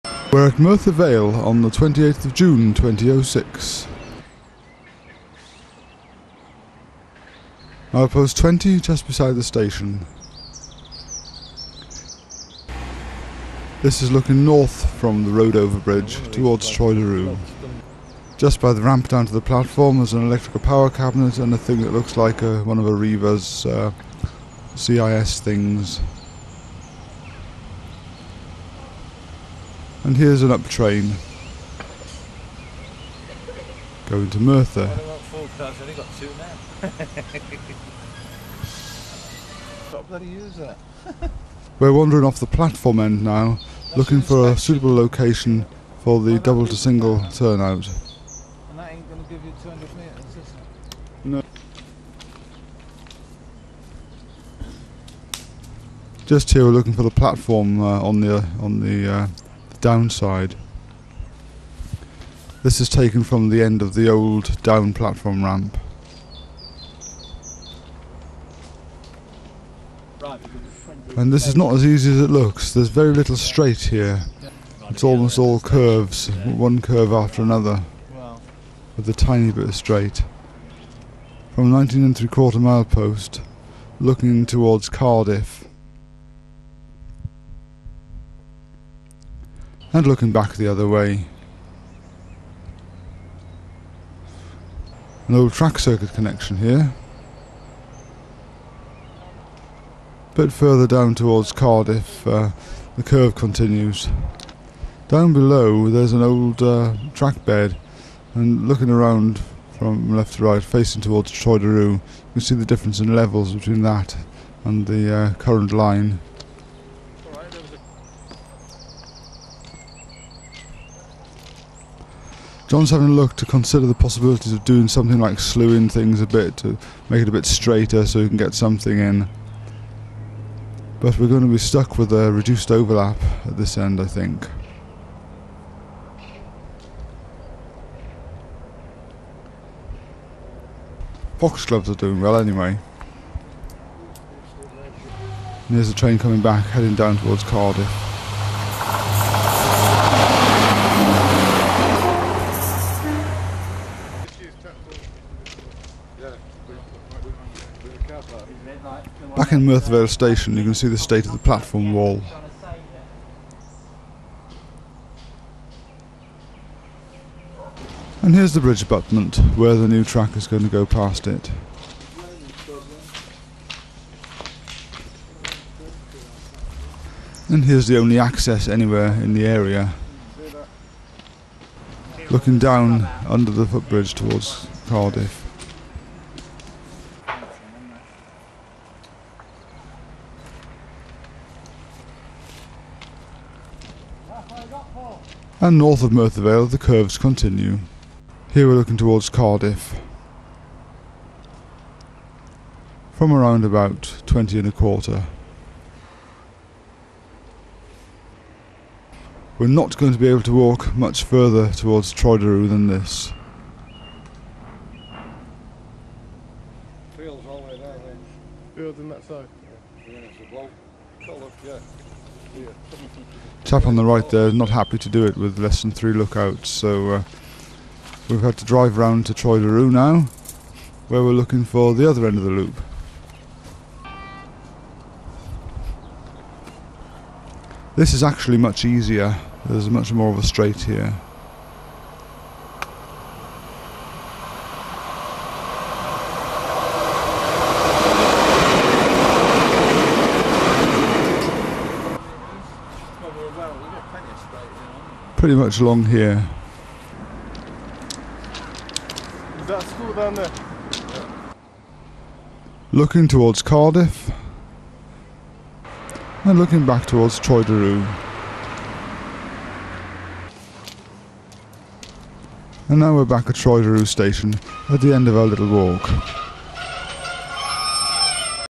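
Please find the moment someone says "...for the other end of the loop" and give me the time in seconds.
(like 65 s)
231 s.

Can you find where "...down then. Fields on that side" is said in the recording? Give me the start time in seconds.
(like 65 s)
217 s.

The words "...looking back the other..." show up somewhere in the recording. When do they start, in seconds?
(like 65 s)
90 s.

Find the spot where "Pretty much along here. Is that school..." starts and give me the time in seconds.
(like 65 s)
255 s.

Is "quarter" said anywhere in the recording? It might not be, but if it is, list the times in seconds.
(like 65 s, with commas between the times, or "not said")
82 s, 204 s.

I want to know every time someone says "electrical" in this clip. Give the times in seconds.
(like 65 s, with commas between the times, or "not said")
20 s.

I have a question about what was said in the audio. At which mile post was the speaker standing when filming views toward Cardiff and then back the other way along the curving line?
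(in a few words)
19¾.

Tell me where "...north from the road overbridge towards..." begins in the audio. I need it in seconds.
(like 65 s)
14 s.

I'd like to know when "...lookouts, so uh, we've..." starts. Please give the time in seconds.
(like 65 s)
226 s.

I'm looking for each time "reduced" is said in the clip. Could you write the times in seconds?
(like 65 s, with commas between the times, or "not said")
132 s.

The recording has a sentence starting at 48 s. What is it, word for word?
And that ain't going to give you 200 metres, is it?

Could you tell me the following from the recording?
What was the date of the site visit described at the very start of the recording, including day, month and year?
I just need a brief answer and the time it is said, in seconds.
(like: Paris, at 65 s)
28 June 2006, at 1 s.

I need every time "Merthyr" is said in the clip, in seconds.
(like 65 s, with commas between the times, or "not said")
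0 s, 34 s, 159 s, 196 s.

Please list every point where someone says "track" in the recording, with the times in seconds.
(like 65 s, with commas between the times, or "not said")
95 s, 107 s, 170 s.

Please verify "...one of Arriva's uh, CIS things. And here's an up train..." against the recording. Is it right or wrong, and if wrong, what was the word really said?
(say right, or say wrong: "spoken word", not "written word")
right.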